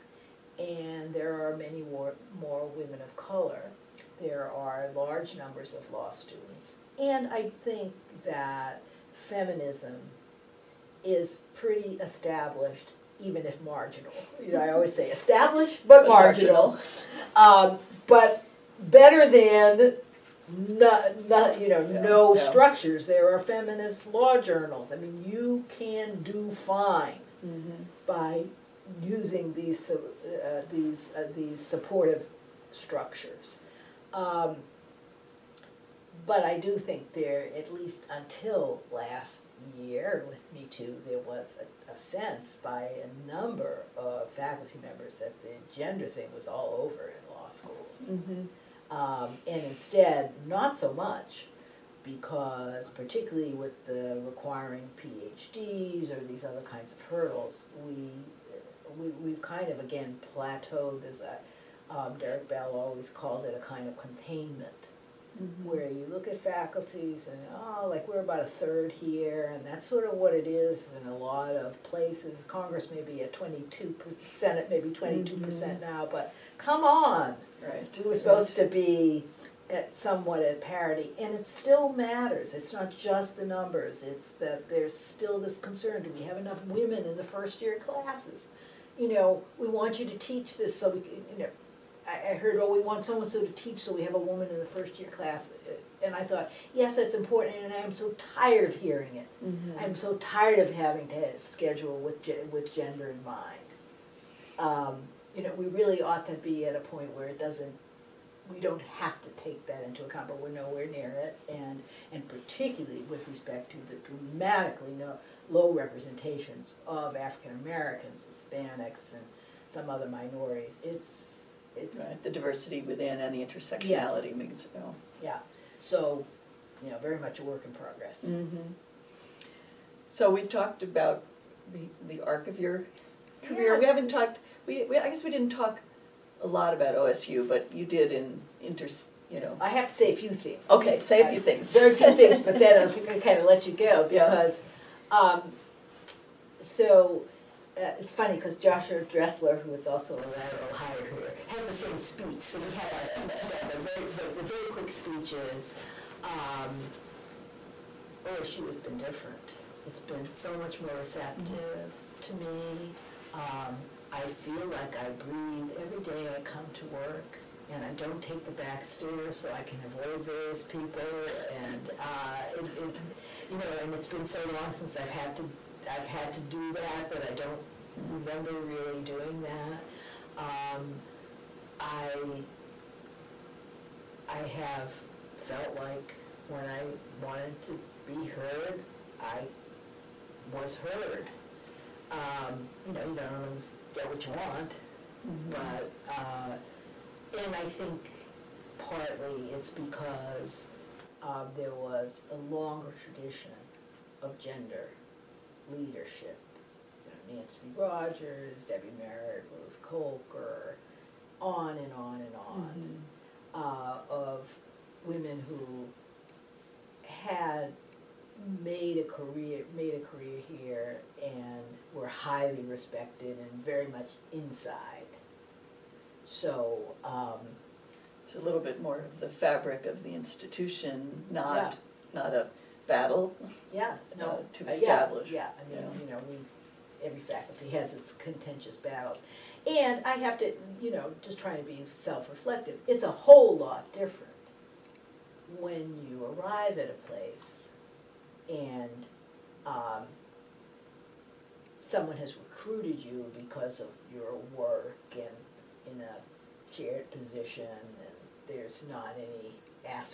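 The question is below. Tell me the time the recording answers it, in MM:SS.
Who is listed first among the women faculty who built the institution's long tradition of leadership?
03:27.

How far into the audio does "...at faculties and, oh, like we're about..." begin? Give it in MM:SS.
01:06.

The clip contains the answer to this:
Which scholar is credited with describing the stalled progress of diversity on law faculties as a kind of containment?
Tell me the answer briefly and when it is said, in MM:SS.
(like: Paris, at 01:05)
Derek Bell, at 01:02.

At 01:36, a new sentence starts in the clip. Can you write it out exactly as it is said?
And I thought, yes, that's important, and I'm so tired of hearing it.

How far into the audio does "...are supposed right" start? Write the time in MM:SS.
01:18.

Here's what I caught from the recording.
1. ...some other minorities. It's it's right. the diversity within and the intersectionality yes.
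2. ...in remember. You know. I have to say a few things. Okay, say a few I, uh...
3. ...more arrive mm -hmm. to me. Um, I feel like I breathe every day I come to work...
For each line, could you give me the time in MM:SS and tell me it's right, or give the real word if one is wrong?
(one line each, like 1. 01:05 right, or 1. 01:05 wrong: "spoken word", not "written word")
1. 01:59 right
2. 02:18 wrong: "inter", not "remember"
3. 02:40 wrong: "receptive", not "arrive".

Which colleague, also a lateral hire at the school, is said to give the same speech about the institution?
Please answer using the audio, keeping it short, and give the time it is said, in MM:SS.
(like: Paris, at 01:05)
Joshua Dressler, at 02:28.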